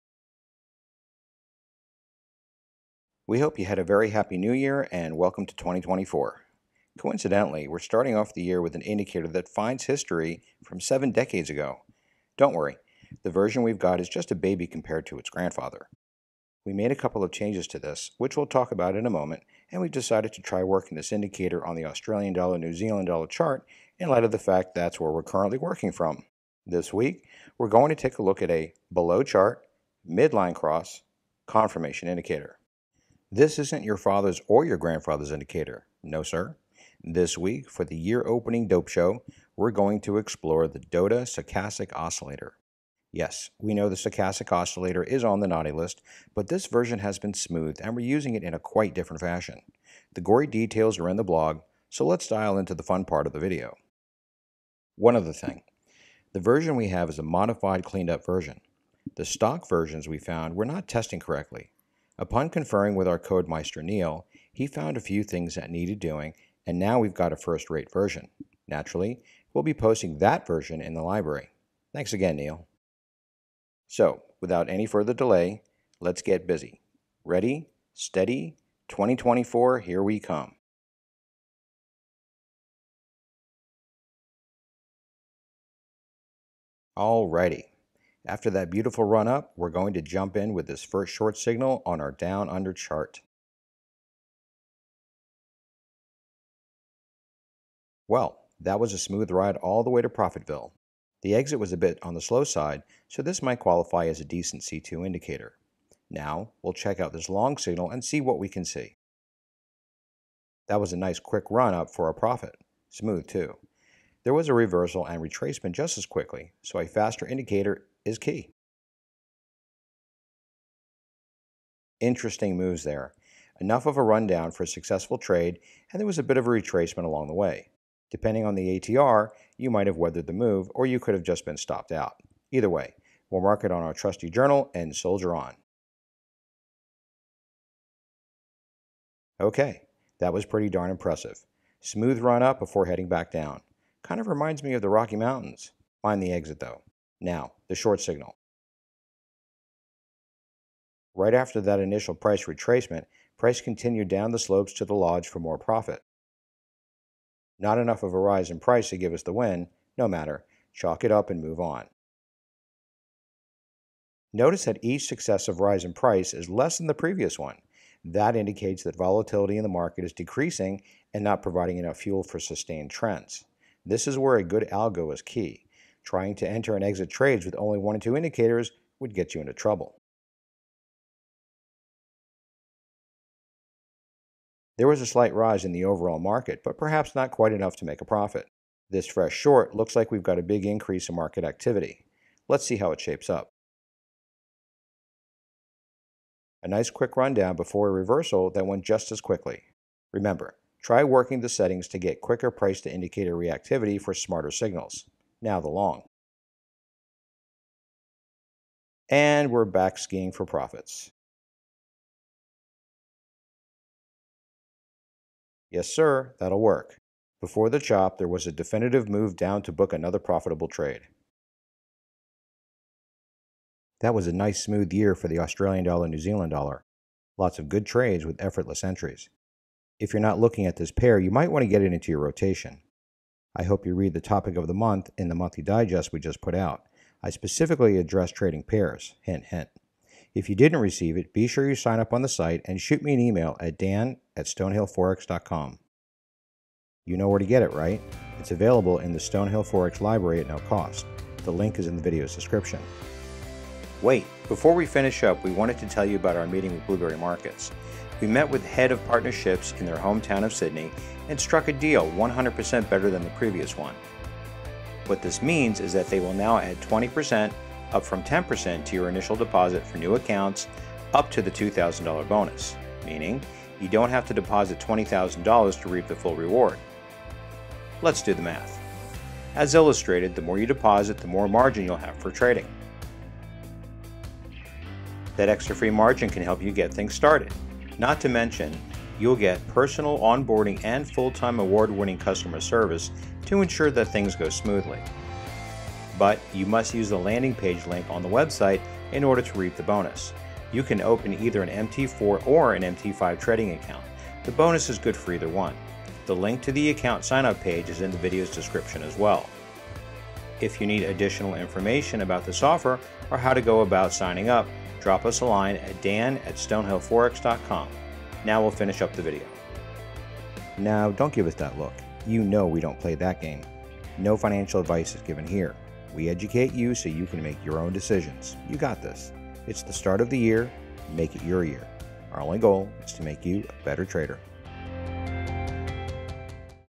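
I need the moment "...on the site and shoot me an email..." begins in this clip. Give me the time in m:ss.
4:02.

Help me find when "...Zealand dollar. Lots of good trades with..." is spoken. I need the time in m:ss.
3:46.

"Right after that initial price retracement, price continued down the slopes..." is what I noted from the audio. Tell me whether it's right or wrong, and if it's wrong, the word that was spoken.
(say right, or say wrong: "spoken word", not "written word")
right.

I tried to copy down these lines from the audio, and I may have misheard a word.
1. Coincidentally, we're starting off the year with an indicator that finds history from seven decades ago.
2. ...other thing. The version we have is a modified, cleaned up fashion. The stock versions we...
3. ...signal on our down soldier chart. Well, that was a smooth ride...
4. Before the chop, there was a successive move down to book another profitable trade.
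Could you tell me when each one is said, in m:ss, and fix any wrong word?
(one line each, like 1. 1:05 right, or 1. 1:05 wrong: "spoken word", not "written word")
1. 0:06 right
2. 0:55 wrong: "version", not "fashion"
3. 1:31 wrong: "under", not "soldier"
4. 3:37 wrong: "definitive", not "successive".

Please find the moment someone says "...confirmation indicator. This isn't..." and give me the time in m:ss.
0:31.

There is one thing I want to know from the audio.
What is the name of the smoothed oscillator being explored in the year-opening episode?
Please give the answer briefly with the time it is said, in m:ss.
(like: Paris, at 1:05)
Doda Stochastic Oscillator, at 0:40.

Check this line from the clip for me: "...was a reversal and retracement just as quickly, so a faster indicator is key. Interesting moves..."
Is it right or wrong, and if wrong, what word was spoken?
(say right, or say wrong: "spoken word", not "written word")
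right.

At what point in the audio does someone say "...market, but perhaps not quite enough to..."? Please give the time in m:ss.
3:06.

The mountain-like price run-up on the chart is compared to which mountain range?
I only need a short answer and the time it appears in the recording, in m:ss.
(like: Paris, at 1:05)
Rocky Mountains, at 2:24.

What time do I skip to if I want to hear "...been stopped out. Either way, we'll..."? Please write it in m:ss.
2:11.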